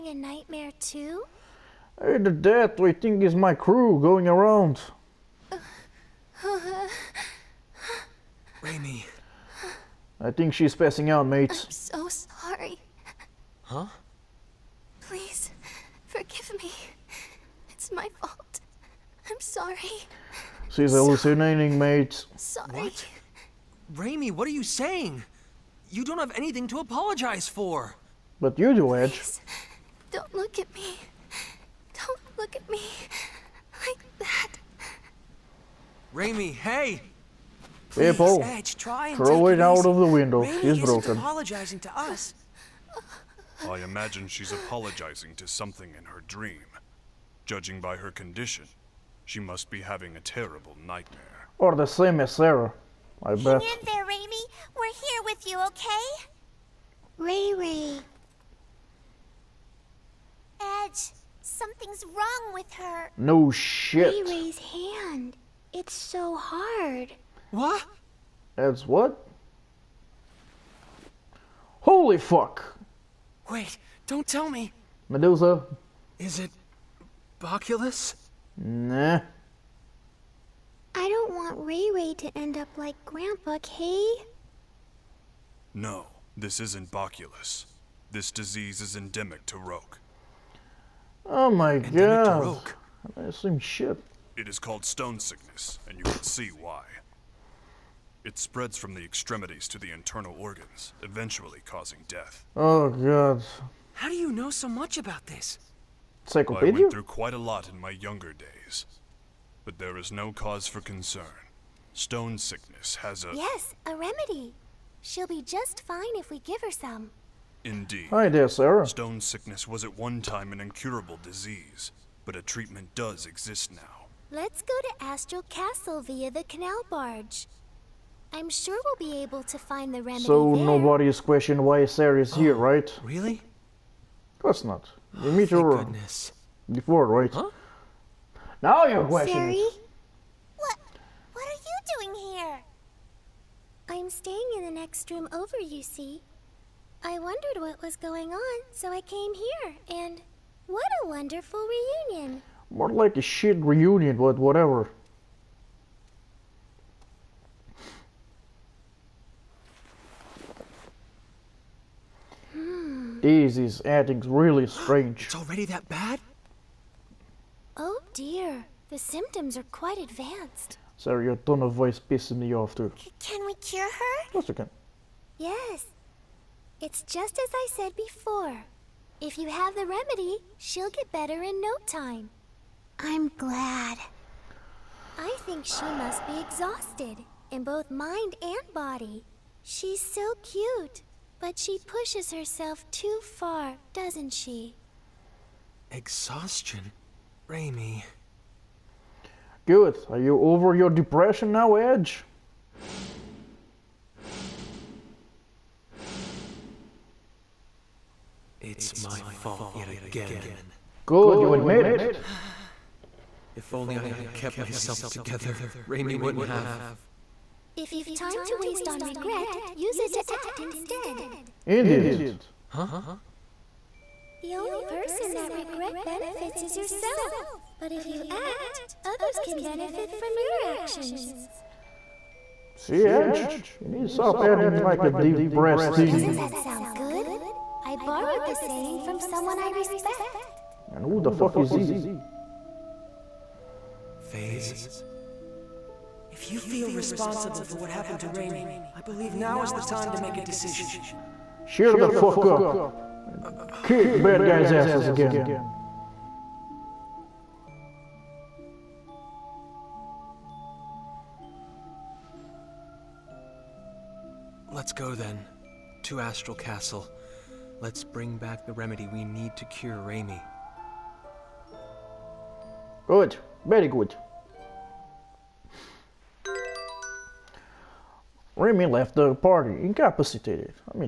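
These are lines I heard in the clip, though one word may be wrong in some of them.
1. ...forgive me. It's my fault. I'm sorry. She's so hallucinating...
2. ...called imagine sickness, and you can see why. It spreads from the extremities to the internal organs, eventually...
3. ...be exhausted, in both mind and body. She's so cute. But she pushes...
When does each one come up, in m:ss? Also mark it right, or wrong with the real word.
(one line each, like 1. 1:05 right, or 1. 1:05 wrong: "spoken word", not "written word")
1. 0:16 right
2. 1:34 wrong: "stone", not "imagine"
3. 3:06 right.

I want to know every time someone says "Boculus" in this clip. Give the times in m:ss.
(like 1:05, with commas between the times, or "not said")
1:17, 1:26.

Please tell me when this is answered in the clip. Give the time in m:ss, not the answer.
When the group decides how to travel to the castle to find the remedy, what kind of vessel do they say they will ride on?
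2:06.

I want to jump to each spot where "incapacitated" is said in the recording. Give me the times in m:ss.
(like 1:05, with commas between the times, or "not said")
4:39.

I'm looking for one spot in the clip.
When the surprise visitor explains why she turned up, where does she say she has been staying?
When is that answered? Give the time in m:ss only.
2:24.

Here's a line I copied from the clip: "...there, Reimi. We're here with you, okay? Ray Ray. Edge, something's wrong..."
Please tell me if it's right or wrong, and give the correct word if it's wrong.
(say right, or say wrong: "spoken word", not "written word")
right.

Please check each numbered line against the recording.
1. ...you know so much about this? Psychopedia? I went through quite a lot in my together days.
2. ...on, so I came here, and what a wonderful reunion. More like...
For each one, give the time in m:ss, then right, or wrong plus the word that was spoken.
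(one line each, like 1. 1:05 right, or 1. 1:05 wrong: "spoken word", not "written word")
1. 1:44 wrong: "younger", not "together"
2. 2:28 right.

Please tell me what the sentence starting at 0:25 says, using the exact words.
You don't have anything to apologize for.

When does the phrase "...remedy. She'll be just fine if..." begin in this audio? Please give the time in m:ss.
1:53.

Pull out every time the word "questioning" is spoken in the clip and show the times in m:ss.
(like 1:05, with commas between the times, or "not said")
2:11, 2:19.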